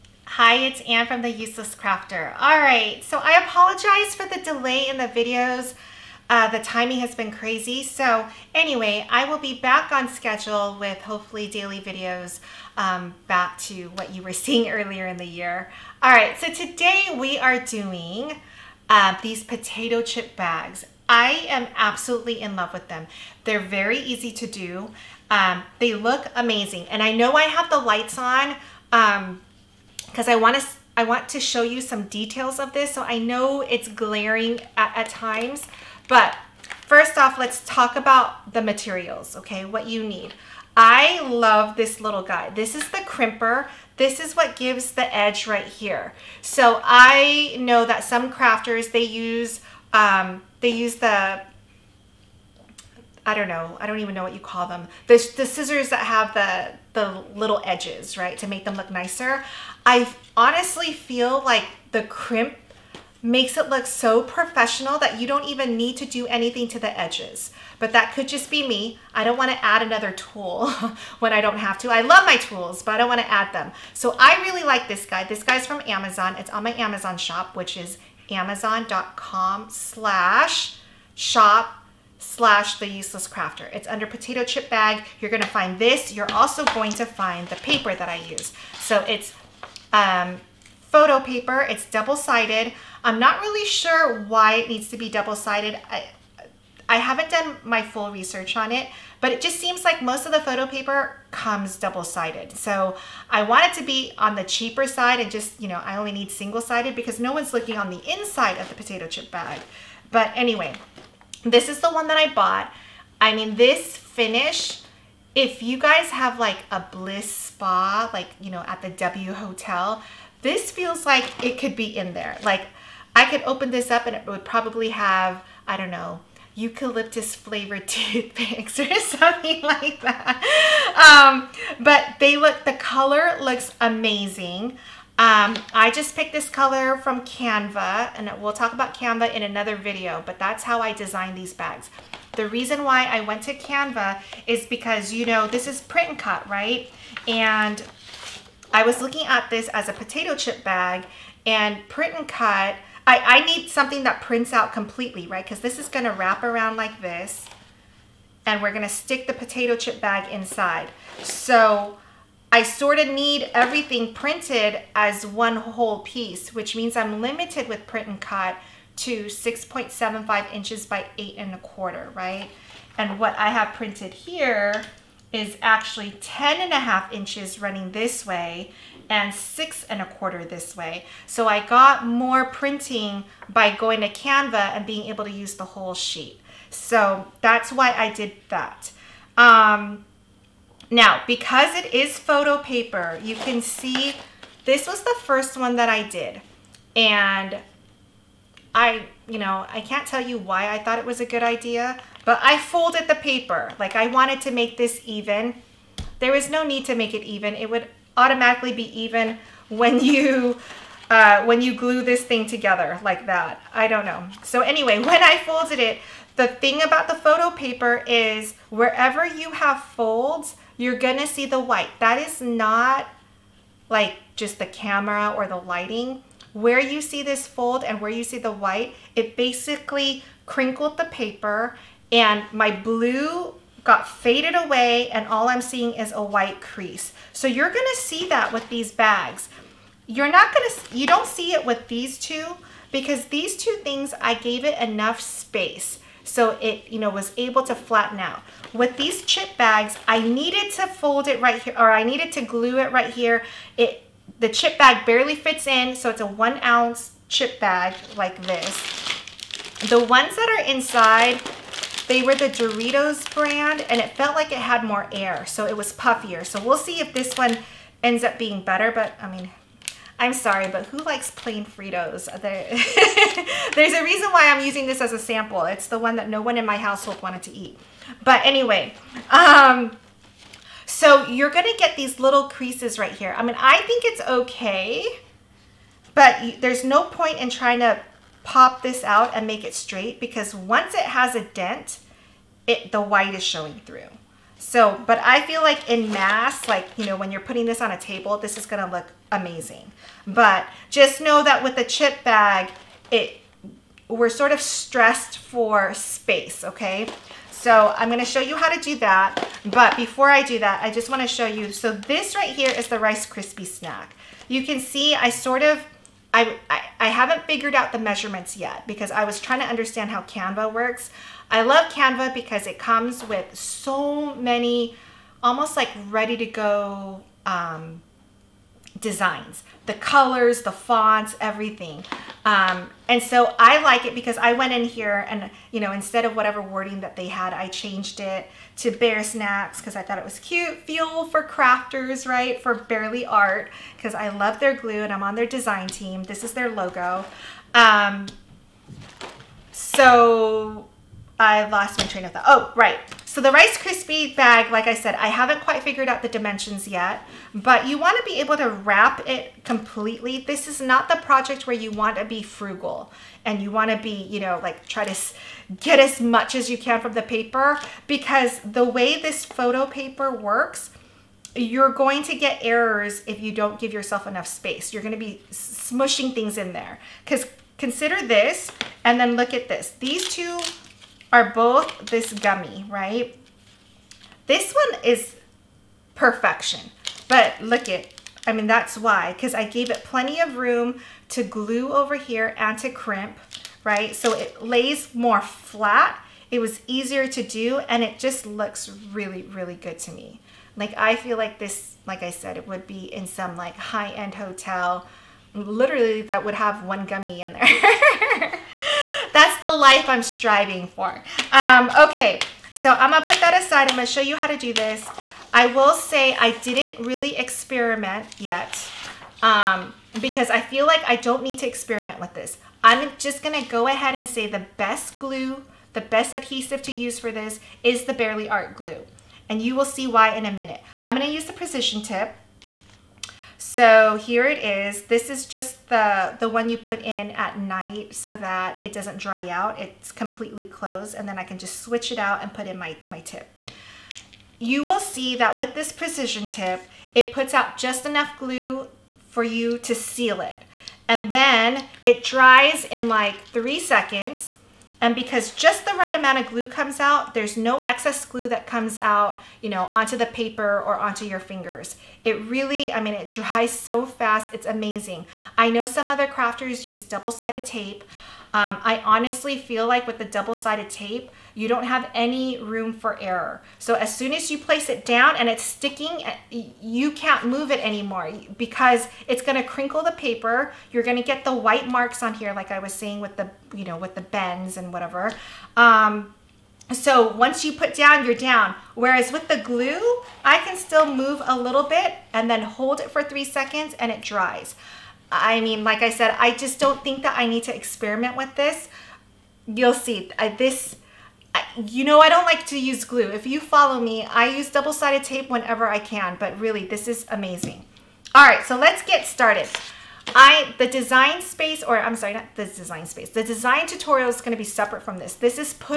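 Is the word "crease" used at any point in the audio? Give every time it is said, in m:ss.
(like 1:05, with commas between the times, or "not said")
3:56, 4:42.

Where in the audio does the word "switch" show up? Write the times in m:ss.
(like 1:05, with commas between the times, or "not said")
7:21.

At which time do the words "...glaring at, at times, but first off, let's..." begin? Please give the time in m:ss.
0:33.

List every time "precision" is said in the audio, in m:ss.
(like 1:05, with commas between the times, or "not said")
7:11, 7:25.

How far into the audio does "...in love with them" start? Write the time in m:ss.
0:22.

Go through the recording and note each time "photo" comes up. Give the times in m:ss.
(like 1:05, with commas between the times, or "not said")
1:30, 1:40, 3:12, 3:37, 6:09.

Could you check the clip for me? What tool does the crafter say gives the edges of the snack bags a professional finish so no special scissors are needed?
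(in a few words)
crimper.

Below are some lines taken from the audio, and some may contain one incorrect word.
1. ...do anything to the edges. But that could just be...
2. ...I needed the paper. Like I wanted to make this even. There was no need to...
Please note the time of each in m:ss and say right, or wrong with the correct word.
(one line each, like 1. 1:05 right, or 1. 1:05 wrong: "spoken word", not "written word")
1. 1:06 right
2. 3:22 wrong: "folded", not "needed".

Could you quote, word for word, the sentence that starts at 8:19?
You'll see, I, this you know I don't like to use glue.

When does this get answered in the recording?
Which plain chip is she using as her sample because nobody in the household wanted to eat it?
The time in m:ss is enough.
4:31.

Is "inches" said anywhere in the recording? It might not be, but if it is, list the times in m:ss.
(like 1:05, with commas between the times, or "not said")
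2:50, 2:57.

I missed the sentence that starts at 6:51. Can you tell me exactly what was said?
Um, okay, so I'm gonna put that aside.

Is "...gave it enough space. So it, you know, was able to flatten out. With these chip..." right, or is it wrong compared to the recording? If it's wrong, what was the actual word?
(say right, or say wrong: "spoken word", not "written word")
right.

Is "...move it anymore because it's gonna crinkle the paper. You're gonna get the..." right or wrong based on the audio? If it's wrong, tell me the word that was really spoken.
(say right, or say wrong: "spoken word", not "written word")
right.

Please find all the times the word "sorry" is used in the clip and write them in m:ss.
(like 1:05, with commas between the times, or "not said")
4:30, 8:32.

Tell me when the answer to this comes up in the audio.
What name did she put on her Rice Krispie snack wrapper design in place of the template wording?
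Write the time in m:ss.
5:38.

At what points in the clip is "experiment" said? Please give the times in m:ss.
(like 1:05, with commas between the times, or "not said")
6:57, 7:01, 8:17.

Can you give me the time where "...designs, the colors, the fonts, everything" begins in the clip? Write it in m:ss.
5:28.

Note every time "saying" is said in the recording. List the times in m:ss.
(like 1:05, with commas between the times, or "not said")
8:02.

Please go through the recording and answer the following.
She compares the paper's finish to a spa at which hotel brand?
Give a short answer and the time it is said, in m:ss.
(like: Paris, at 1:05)
W Hotel, at 1:58.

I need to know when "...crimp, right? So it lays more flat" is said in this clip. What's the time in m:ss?
6:32.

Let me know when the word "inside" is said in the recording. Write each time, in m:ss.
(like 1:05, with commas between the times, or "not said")
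1:48, 2:40, 4:20.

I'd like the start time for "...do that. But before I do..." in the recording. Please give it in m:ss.
5:08.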